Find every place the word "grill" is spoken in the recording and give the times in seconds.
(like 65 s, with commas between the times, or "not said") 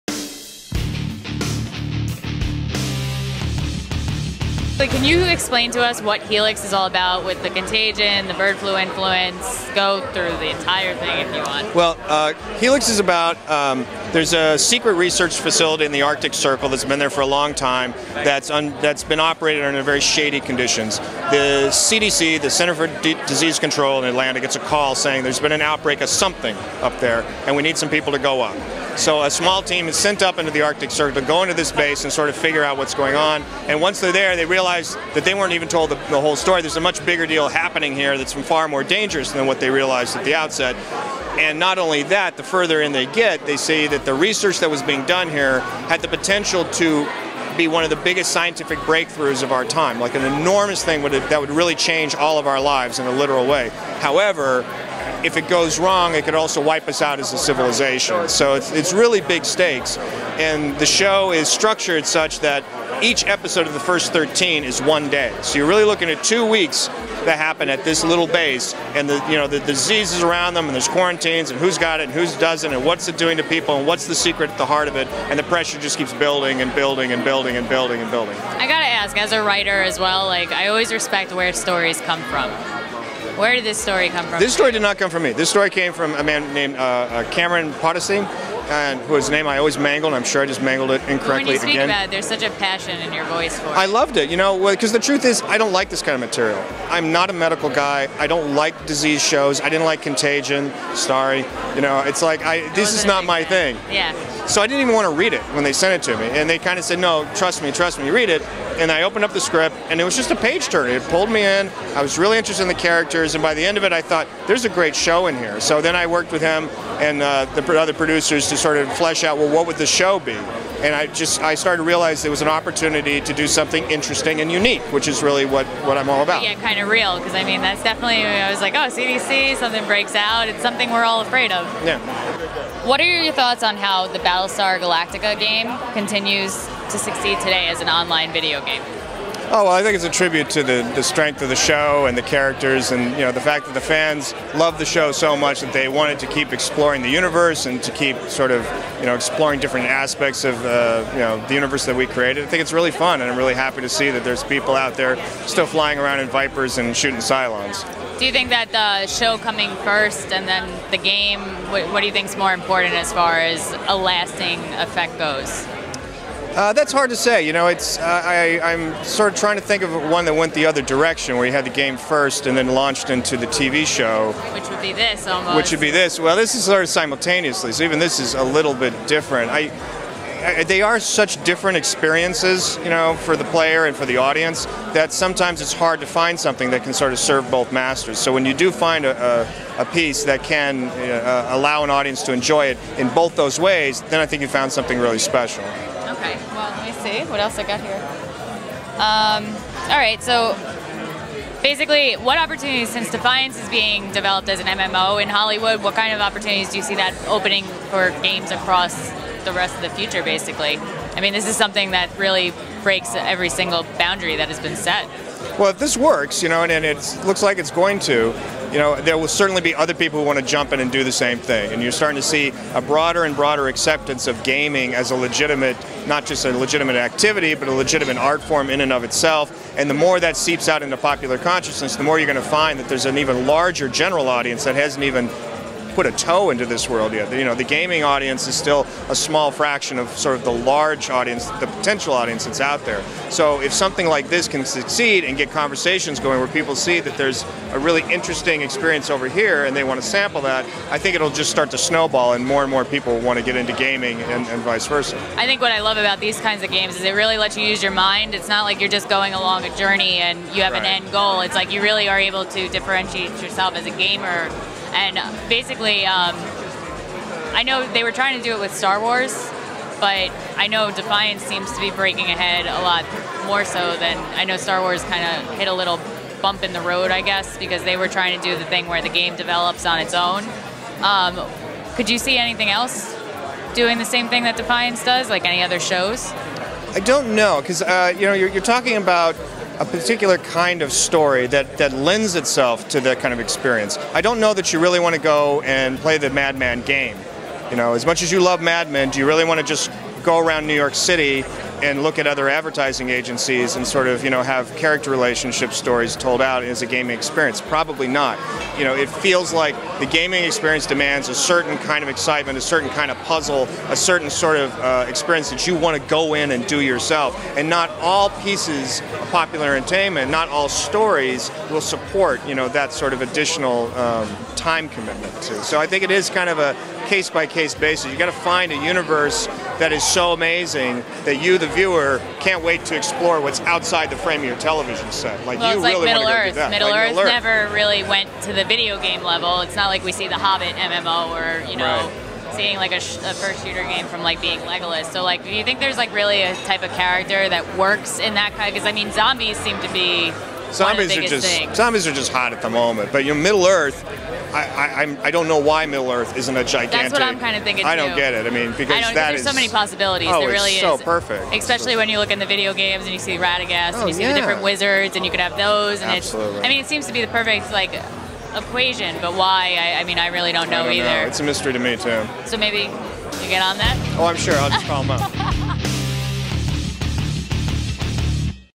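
not said.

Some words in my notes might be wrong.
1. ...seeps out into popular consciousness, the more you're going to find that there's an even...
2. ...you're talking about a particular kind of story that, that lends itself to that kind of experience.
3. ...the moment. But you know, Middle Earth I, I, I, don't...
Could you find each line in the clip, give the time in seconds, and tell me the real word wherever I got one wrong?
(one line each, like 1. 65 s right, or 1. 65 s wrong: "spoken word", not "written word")
1. 230 s right
2. 288 s right
3. 352 s right.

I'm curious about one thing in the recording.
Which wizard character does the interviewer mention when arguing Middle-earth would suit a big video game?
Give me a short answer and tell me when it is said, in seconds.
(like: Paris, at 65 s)
Radagast, at 363 s.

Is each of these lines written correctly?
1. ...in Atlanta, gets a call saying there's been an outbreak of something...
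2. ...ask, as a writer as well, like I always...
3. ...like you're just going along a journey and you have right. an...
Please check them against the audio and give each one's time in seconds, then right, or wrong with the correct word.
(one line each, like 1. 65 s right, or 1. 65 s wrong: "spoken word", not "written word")
1. 24 s right
2. 78 s right
3. 258 s right.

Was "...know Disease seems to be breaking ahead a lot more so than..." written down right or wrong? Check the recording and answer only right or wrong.
wrong.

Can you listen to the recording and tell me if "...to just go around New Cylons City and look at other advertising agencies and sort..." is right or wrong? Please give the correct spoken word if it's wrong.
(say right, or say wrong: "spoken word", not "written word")
wrong: "York", not "Cylons".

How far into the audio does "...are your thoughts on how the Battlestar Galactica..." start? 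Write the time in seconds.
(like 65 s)
132 s.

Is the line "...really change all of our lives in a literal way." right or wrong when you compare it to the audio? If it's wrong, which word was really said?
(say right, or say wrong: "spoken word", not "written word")
right.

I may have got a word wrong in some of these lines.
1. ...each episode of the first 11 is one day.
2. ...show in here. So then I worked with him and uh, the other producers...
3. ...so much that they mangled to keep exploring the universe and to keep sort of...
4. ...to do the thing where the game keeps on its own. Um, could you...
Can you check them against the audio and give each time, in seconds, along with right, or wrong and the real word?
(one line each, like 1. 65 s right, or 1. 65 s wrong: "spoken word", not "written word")
1. 63 s wrong: "13", not "11"
2. 114 s right
3. 145 s wrong: "wanted", not "mangled"
4. 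278 s wrong: "develops", not "keeps".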